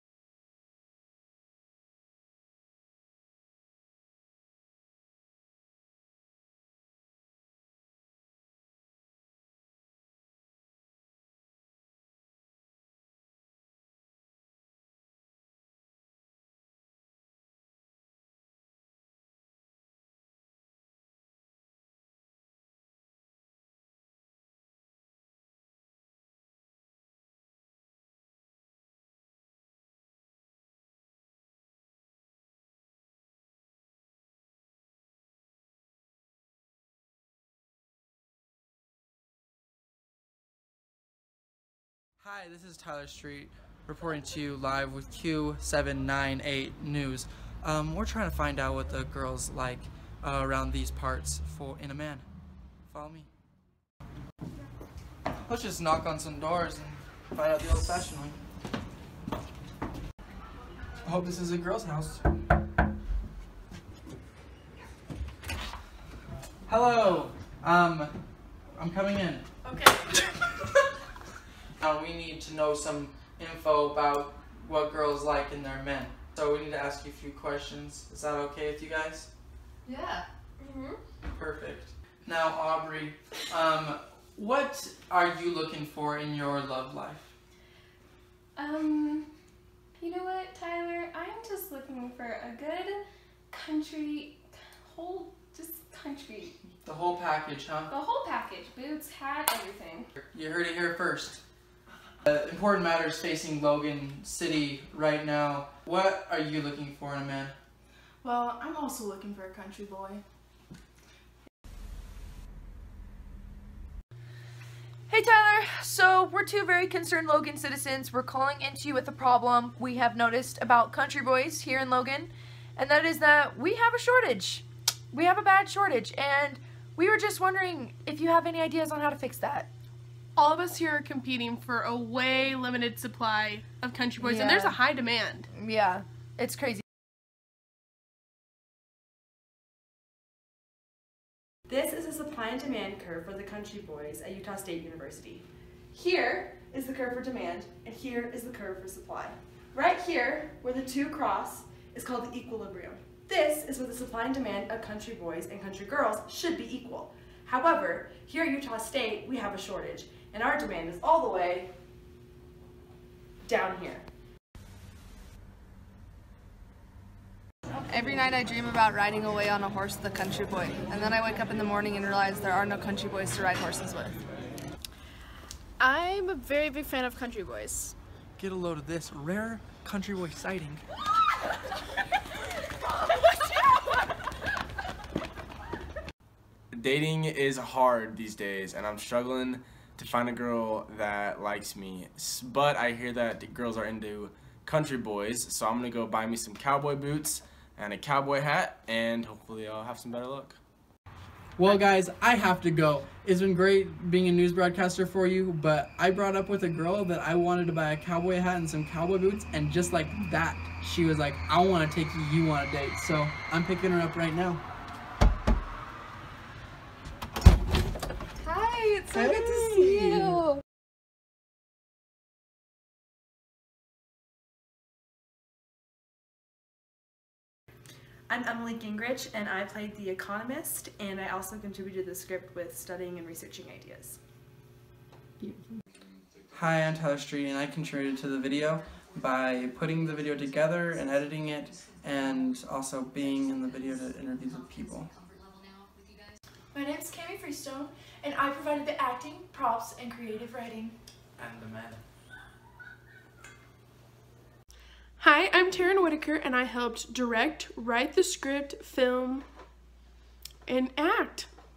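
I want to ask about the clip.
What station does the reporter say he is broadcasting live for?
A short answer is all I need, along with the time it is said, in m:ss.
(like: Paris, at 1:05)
Q798 News, at 0:45.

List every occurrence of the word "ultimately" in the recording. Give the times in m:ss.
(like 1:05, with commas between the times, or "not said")
not said.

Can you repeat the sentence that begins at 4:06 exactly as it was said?
My name is Cami Freestone, and I provided the acting, props, and creative writing.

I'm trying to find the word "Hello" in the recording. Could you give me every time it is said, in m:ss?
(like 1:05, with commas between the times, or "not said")
1:06.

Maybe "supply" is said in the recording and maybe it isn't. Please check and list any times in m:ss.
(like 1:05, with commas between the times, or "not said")
2:12, 2:22, 2:28, 2:33.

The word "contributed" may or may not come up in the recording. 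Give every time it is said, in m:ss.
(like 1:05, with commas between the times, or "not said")
3:51, 3:57.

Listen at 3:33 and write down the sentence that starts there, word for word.
So I'm picking her up right now.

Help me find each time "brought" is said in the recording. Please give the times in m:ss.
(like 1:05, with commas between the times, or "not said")
3:26.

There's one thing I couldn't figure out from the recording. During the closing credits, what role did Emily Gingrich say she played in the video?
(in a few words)
The Economist.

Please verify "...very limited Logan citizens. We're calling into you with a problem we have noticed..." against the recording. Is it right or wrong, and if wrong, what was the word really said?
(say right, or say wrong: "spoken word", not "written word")
wrong: "concerned", not "limited".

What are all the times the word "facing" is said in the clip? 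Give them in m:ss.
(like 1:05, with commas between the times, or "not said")
1:43.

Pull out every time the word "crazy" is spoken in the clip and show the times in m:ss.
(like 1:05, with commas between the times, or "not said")
2:16.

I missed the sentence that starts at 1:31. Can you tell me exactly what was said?
I'm just looking for a good country, whole, just country.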